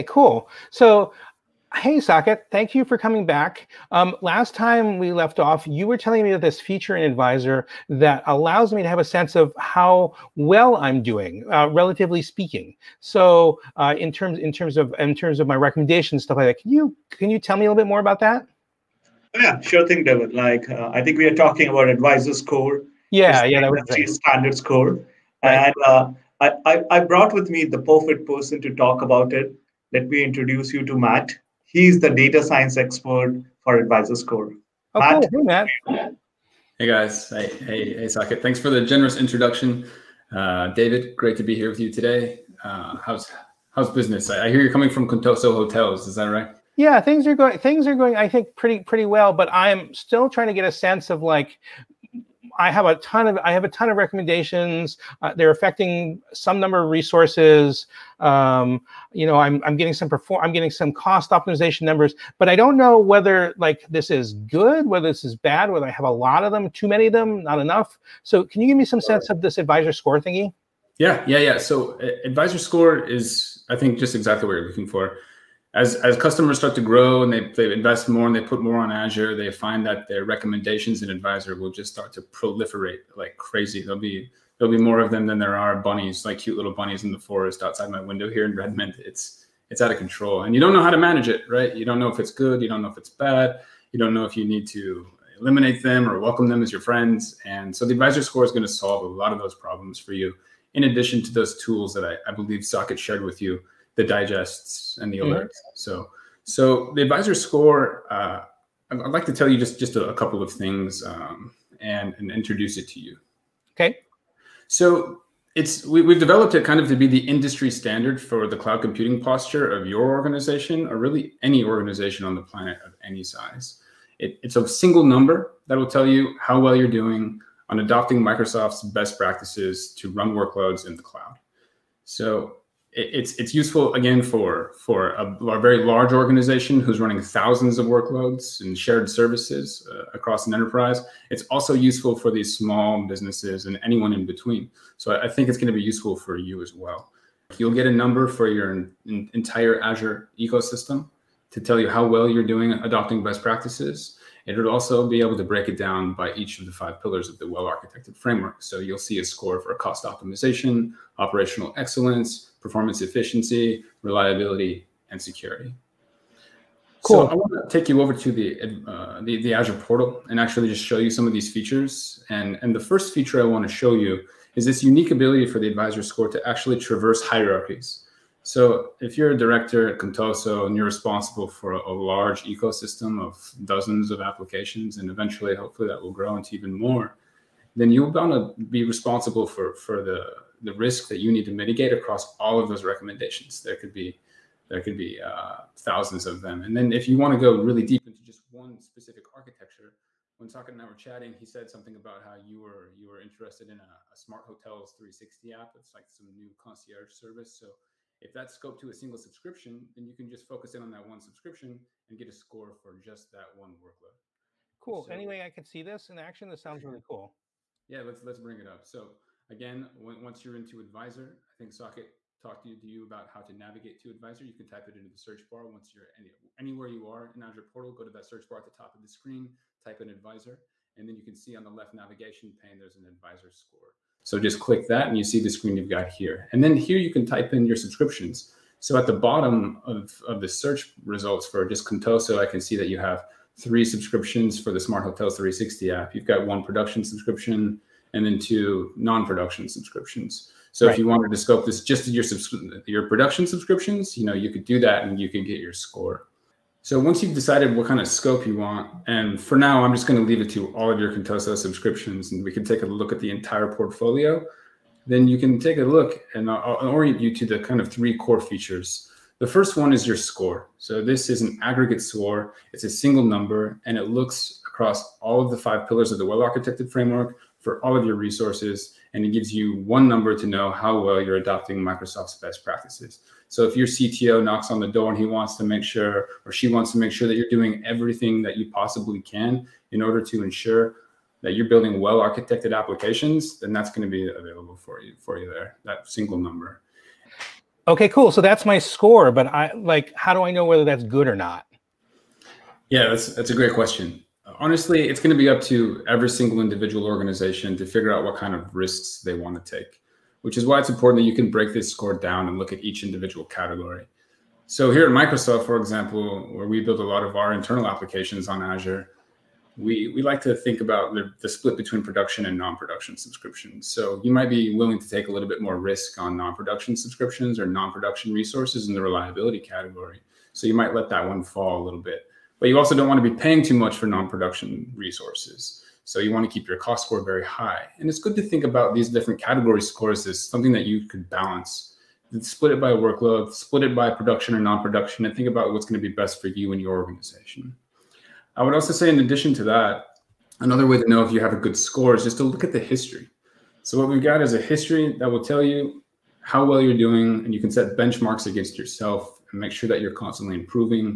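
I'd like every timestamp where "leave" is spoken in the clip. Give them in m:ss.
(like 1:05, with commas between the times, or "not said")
4:20.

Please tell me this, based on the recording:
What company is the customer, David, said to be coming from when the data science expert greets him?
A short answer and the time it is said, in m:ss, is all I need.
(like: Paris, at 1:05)
Contoso Hotels, at 0:45.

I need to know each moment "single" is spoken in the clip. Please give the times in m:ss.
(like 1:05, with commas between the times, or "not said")
2:04, 3:28, 4:32, 4:56, 5:06.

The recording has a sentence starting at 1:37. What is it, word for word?
And so the advisor score is going to solve a lot of those problems for you.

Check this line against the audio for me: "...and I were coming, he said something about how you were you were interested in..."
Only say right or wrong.
wrong.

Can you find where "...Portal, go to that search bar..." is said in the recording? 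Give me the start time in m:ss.
3:47.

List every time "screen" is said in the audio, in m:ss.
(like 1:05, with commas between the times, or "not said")
3:49, 3:55.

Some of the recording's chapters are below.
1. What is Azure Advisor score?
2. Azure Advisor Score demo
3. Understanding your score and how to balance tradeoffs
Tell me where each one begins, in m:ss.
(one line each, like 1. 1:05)
1. 1:46
2. 3:34
3. 5:00.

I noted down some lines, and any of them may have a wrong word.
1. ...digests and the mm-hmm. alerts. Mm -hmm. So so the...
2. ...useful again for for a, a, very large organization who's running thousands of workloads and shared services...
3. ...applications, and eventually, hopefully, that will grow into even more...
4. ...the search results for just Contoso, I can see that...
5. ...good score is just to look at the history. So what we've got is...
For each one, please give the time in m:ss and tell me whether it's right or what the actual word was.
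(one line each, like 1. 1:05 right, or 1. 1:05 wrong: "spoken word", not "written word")
1. 1:44 right
2. 2:13 right
3. 3:04 right
4. 4:00 right
5. 5:51 right.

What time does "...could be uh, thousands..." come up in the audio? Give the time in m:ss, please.
3:14.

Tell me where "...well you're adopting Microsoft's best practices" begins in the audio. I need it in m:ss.
4:40.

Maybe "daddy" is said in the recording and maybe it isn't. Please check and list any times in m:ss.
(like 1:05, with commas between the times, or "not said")
not said.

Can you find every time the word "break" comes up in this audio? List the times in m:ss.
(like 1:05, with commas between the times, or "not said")
2:35, 5:11.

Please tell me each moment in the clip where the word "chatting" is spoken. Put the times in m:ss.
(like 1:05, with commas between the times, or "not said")
3:20.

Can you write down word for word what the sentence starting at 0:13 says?
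So, uh, in terms in terms of in terms of my recommendations, stuff like that.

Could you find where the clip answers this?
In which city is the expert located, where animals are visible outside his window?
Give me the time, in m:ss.
1:28.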